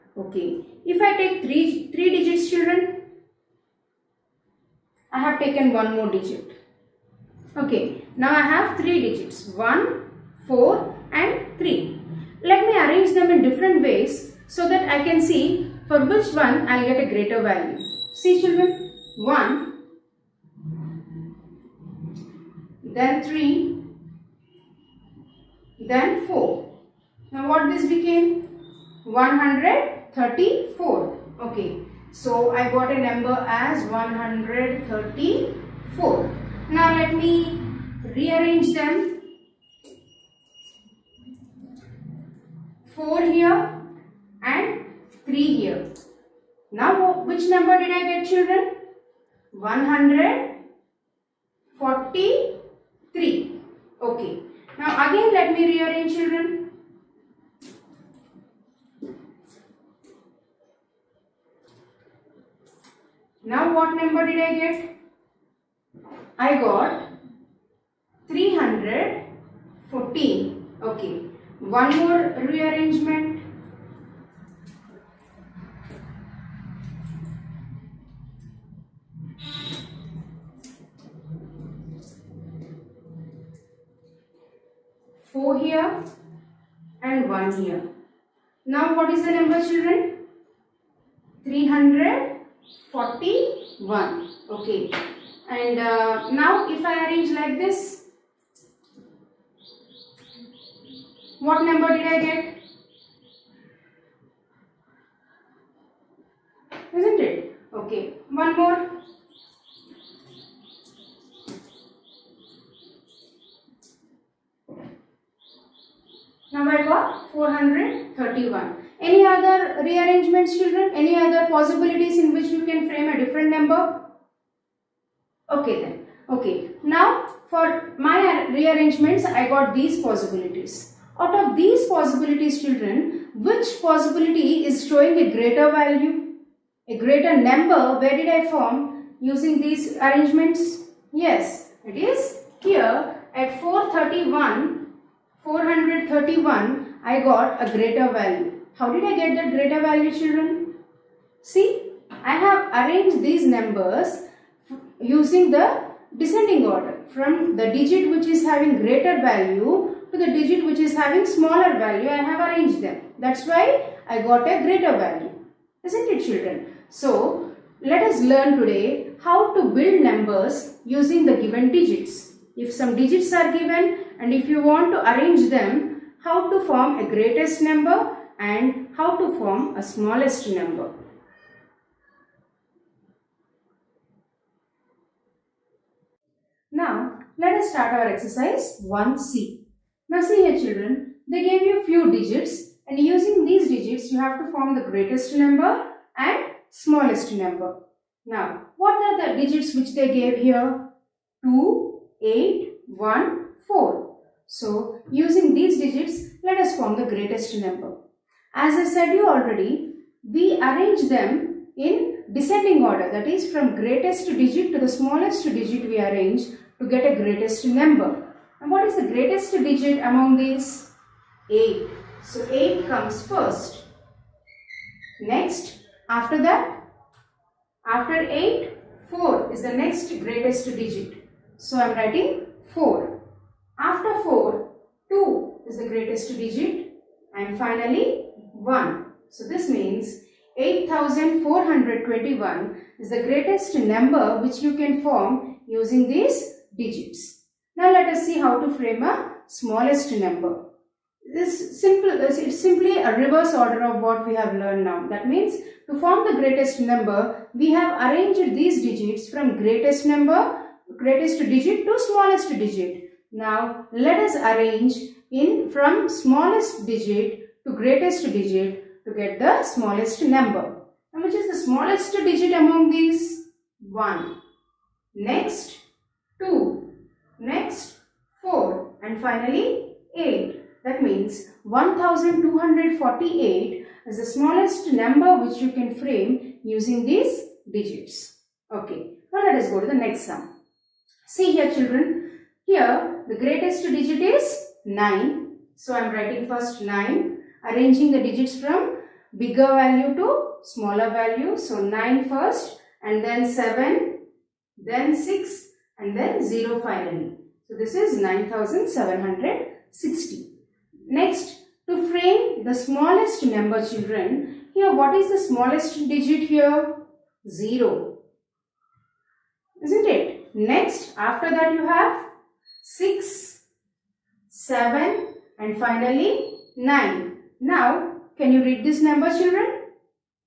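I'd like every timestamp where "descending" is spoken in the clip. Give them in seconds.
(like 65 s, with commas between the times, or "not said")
156 s, 212 s.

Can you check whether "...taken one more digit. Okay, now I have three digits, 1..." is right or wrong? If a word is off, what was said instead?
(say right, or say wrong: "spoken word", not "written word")
right.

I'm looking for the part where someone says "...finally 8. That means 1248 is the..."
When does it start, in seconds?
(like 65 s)
279 s.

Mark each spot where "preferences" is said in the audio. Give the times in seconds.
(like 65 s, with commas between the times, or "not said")
not said.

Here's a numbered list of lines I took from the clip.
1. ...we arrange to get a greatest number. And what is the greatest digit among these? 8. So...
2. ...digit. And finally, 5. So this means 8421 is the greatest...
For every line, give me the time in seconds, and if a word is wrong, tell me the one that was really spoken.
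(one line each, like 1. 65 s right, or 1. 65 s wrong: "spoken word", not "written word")
1. 215 s right
2. 236 s wrong: "1", not "5".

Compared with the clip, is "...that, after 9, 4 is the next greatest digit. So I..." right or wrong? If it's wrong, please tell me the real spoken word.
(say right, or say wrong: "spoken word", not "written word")
wrong: "8", not "9".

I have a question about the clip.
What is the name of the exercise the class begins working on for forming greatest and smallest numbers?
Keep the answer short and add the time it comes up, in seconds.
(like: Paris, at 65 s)
Exercise 1C, at 188 s.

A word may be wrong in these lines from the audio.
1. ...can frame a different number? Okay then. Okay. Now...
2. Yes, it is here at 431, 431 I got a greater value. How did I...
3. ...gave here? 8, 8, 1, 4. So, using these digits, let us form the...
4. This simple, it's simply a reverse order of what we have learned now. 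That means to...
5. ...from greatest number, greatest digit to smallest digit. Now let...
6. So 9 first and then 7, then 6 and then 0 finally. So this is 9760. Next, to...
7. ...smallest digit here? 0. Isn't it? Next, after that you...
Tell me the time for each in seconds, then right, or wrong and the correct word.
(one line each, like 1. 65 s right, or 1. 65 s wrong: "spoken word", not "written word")
1. 122 s right
2. 141 s right
3. 200 s wrong: "2", not "8"
4. 251 s right
5. 259 s right
6. 301 s right
7. 315 s right.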